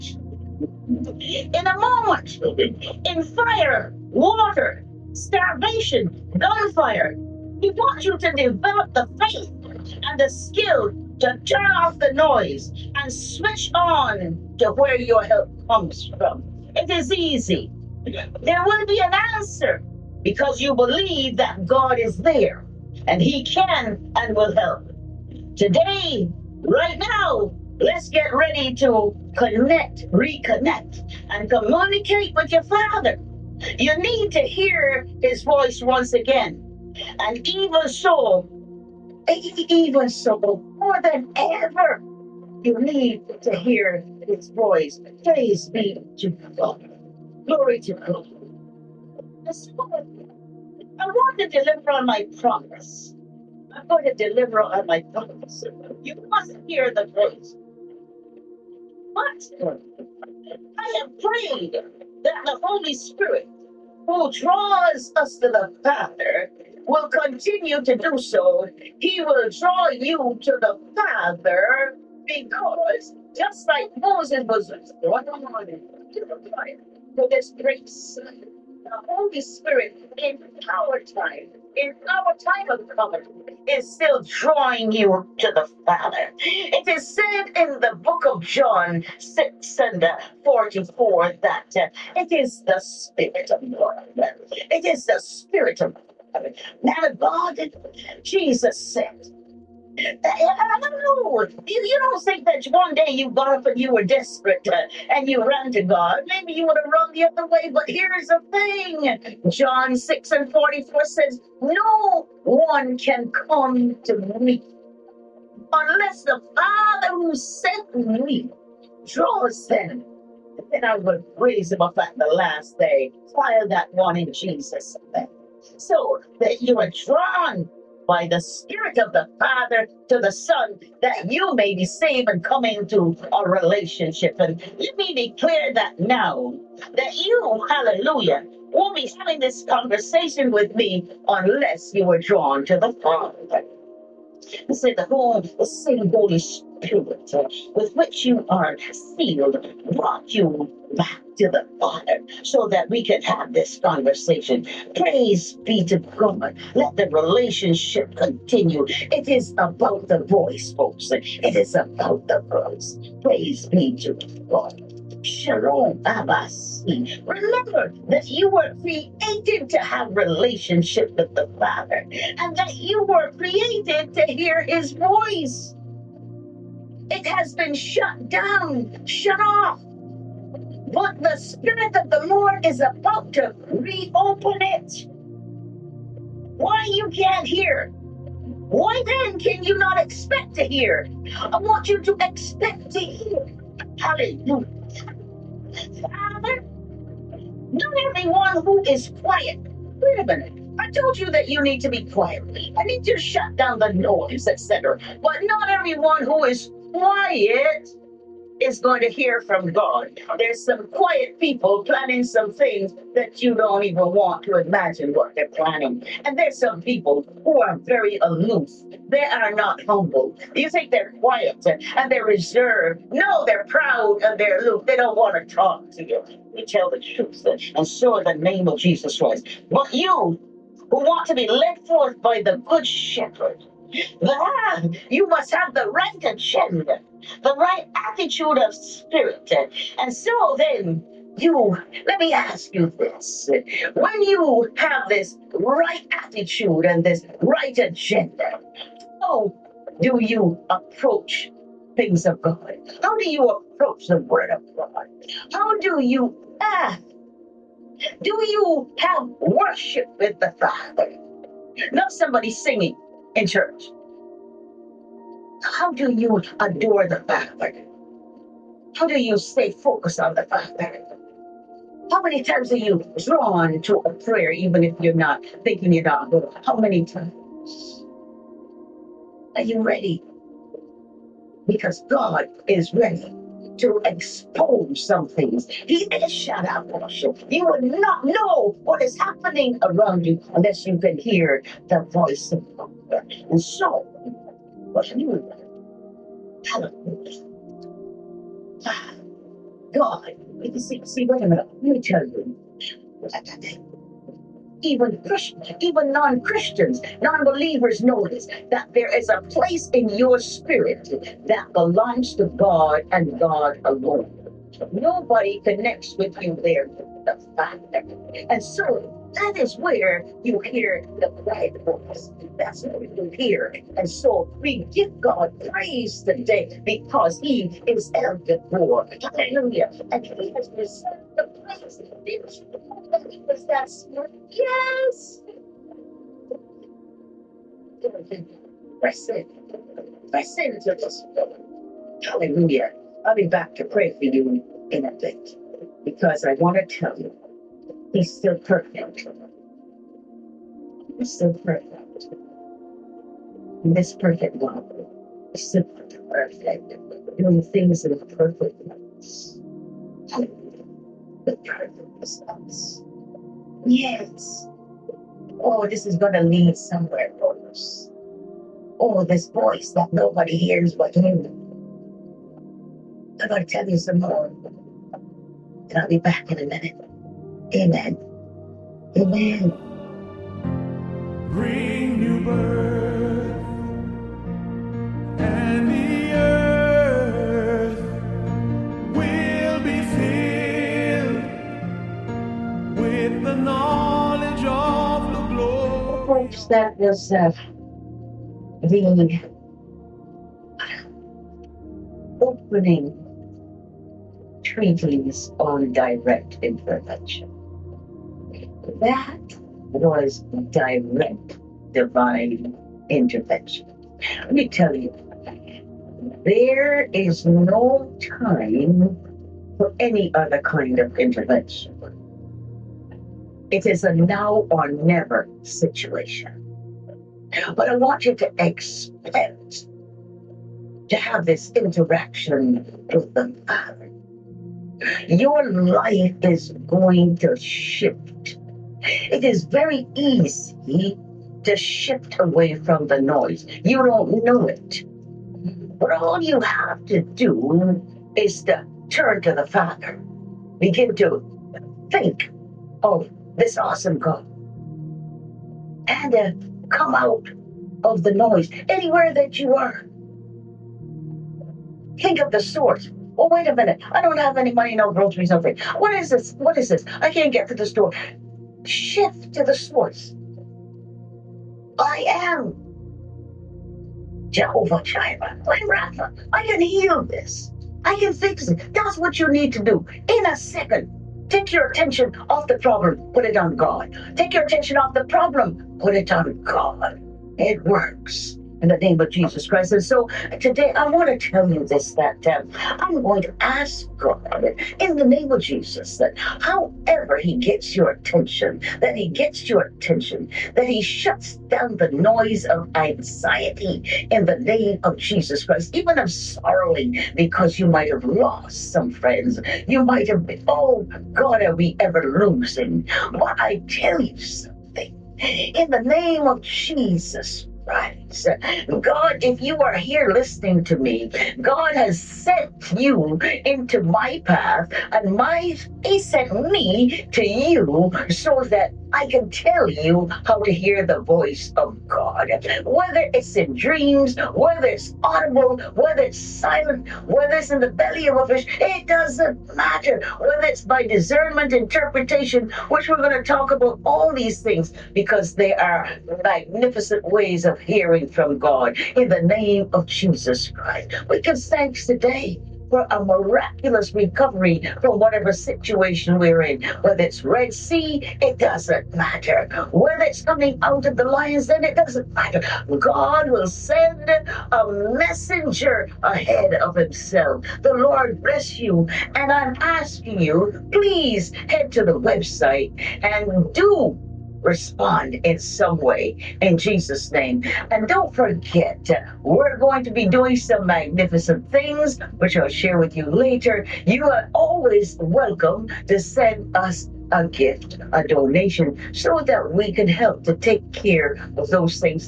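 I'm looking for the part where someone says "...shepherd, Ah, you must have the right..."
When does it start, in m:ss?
3:52.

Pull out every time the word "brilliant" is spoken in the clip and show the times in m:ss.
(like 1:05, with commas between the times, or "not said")
not said.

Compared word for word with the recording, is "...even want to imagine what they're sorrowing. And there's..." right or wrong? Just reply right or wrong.
wrong.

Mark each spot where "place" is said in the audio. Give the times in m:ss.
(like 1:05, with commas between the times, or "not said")
5:09, 5:31.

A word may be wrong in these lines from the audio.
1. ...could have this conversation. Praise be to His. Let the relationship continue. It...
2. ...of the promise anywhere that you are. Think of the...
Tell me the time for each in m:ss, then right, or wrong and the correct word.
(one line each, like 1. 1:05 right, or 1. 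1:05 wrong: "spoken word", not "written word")
1. 2:33 wrong: "God", not "His"
2. 7:38 wrong: "noise", not "promise".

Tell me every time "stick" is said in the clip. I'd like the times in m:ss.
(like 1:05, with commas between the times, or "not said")
not said.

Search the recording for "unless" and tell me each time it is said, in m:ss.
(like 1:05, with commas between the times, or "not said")
1:55, 2:21, 4:50.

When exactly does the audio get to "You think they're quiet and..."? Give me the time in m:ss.
3:40.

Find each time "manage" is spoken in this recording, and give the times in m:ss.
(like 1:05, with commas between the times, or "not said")
not said.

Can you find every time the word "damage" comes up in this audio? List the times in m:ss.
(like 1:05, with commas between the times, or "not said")
not said.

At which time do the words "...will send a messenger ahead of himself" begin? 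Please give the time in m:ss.
9:23.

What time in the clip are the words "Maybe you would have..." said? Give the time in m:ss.
1:46.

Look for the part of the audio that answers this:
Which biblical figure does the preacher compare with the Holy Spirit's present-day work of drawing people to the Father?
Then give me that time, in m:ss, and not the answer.
1:13.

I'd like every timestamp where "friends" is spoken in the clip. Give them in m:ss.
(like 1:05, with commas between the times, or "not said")
8:29.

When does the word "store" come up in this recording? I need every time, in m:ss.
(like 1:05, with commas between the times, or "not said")
7:47.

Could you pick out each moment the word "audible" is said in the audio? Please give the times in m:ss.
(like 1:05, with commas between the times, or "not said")
8:55.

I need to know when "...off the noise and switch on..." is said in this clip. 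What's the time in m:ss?
0:11.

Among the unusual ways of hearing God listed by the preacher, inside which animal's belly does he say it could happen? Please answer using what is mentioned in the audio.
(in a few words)
a fish.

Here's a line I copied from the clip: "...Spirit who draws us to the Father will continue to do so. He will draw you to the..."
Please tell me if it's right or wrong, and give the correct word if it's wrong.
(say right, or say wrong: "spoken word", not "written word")
right.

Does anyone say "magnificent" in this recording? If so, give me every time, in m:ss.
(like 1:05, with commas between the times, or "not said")
9:06, 9:40.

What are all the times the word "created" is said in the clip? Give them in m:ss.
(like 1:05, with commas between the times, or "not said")
2:48, 2:53.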